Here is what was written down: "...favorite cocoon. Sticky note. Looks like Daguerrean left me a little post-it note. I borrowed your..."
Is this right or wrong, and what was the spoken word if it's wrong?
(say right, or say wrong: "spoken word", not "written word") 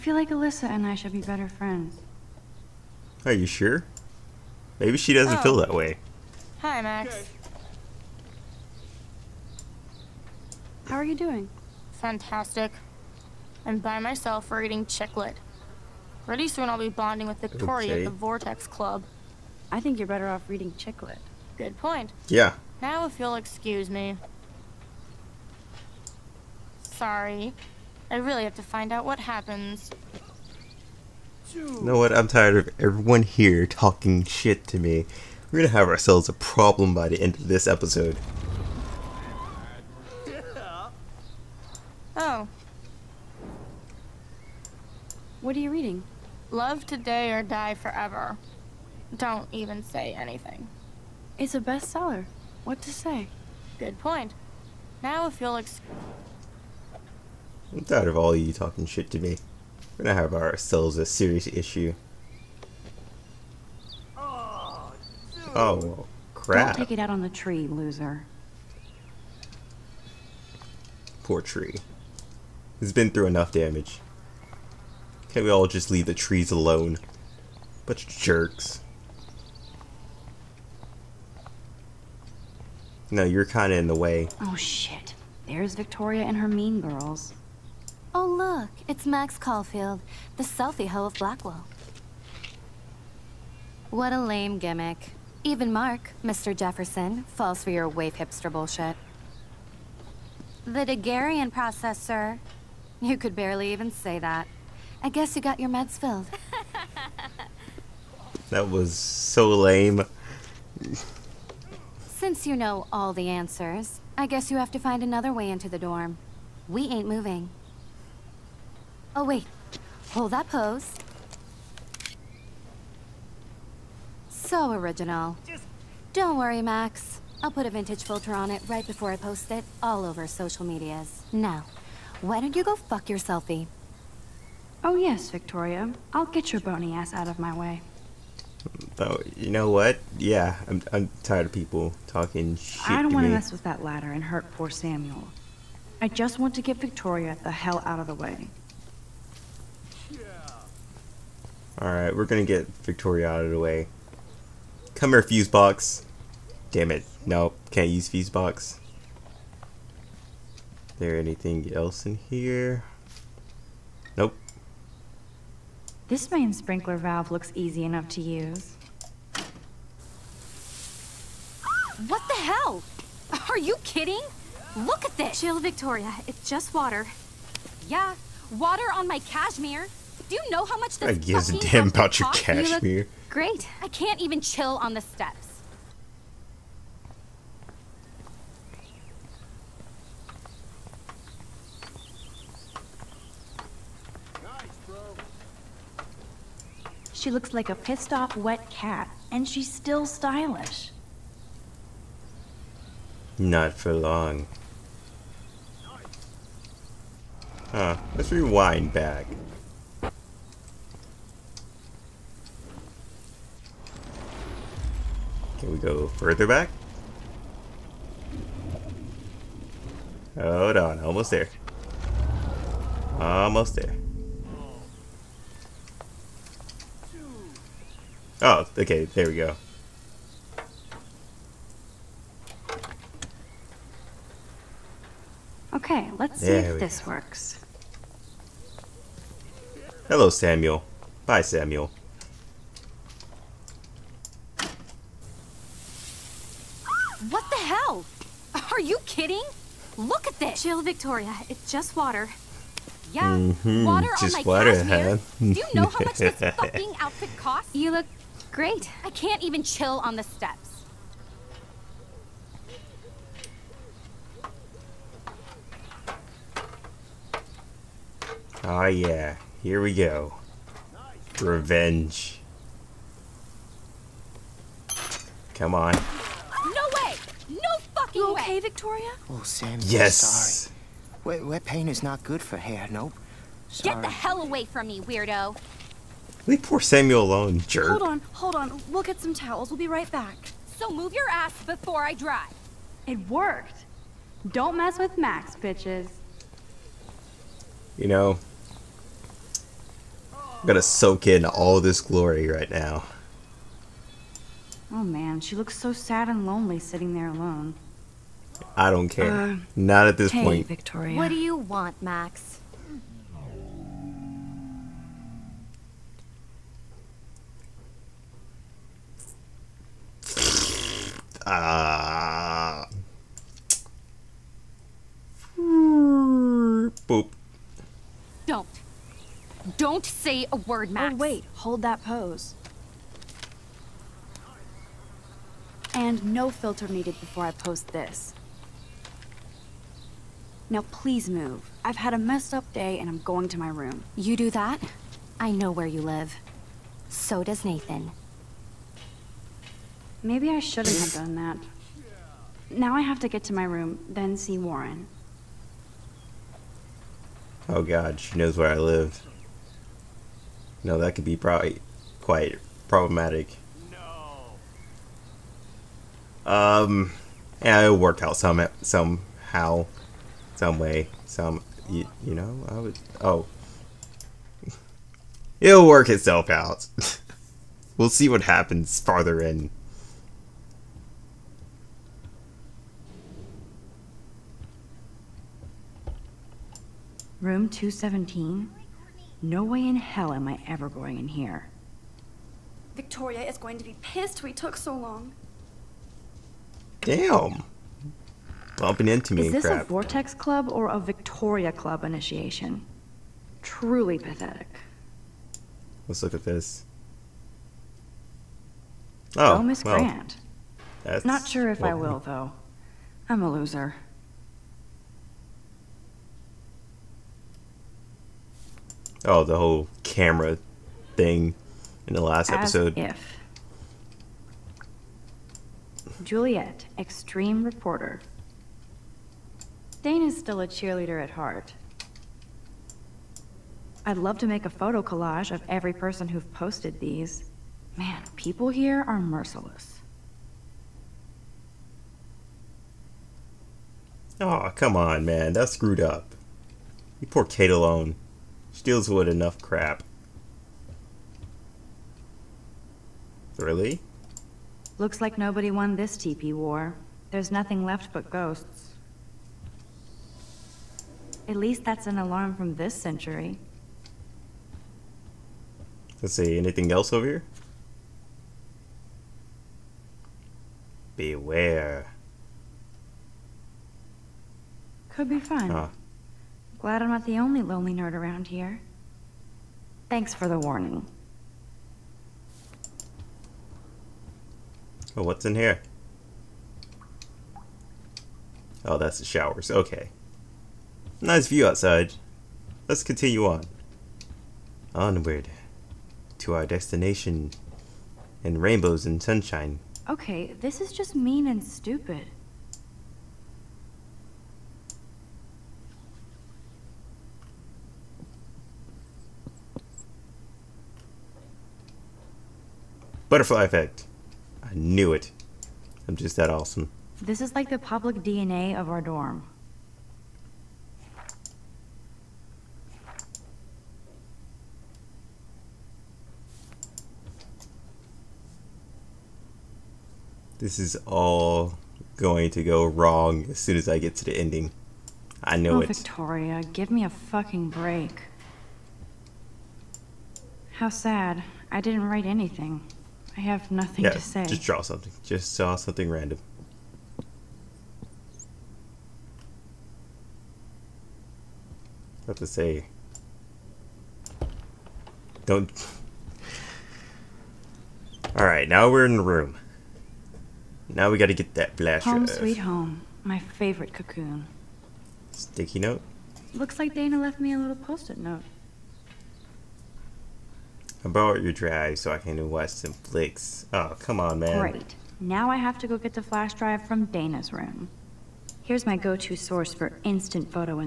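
wrong: "Dana", not "Daguerrean".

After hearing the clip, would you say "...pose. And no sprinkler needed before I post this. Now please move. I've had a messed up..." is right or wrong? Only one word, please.
wrong.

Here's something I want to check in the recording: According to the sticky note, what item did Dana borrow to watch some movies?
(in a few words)
Flash drive.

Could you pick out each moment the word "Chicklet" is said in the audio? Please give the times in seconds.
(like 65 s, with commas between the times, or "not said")
14 s, 20 s.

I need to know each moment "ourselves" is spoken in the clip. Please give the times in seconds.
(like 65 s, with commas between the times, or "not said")
35 s, 60 s.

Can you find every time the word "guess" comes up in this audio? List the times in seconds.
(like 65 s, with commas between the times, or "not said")
105 s, 114 s.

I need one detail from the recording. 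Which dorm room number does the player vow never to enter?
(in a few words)
217.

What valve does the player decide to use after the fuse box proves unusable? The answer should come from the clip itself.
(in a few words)
Main sprinkler valve.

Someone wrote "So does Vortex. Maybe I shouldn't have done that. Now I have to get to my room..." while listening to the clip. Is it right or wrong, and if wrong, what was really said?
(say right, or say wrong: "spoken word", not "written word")
wrong: "Nathan", not "Vortex".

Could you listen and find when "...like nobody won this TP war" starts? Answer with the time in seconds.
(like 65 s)
455 s.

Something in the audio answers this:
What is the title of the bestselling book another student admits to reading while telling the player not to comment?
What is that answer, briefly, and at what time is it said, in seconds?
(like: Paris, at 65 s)
Love today or die forever, at 46 s.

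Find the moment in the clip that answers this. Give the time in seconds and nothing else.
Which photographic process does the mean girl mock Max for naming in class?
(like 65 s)
100 s.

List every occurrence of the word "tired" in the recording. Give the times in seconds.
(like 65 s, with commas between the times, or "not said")
32 s, 57 s, 141 s.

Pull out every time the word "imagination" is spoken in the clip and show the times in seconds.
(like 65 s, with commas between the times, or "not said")
not said.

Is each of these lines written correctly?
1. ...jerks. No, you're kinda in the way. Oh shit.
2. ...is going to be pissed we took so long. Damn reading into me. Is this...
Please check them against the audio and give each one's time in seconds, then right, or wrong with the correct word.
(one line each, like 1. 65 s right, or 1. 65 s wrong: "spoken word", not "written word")
1. 78 s right
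2. 393 s wrong: "bumping", not "reading".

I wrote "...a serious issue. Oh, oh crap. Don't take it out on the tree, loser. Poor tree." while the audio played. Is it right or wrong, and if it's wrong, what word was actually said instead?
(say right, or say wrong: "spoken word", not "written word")
right.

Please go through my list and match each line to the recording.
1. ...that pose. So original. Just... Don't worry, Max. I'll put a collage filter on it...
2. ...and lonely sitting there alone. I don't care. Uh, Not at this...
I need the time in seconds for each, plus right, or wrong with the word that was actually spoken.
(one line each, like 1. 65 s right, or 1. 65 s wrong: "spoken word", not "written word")
1. 120 s wrong: "vintage", not "collage"
2. 306 s right.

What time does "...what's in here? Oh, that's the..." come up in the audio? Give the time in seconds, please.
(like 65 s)
485 s.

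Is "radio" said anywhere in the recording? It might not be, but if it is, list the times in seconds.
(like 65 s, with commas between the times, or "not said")
not said.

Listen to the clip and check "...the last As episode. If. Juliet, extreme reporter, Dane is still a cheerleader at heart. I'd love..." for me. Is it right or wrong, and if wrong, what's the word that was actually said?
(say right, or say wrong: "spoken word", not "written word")
right.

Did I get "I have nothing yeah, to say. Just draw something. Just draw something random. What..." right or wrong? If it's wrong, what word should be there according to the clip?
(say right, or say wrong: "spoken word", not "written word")
right.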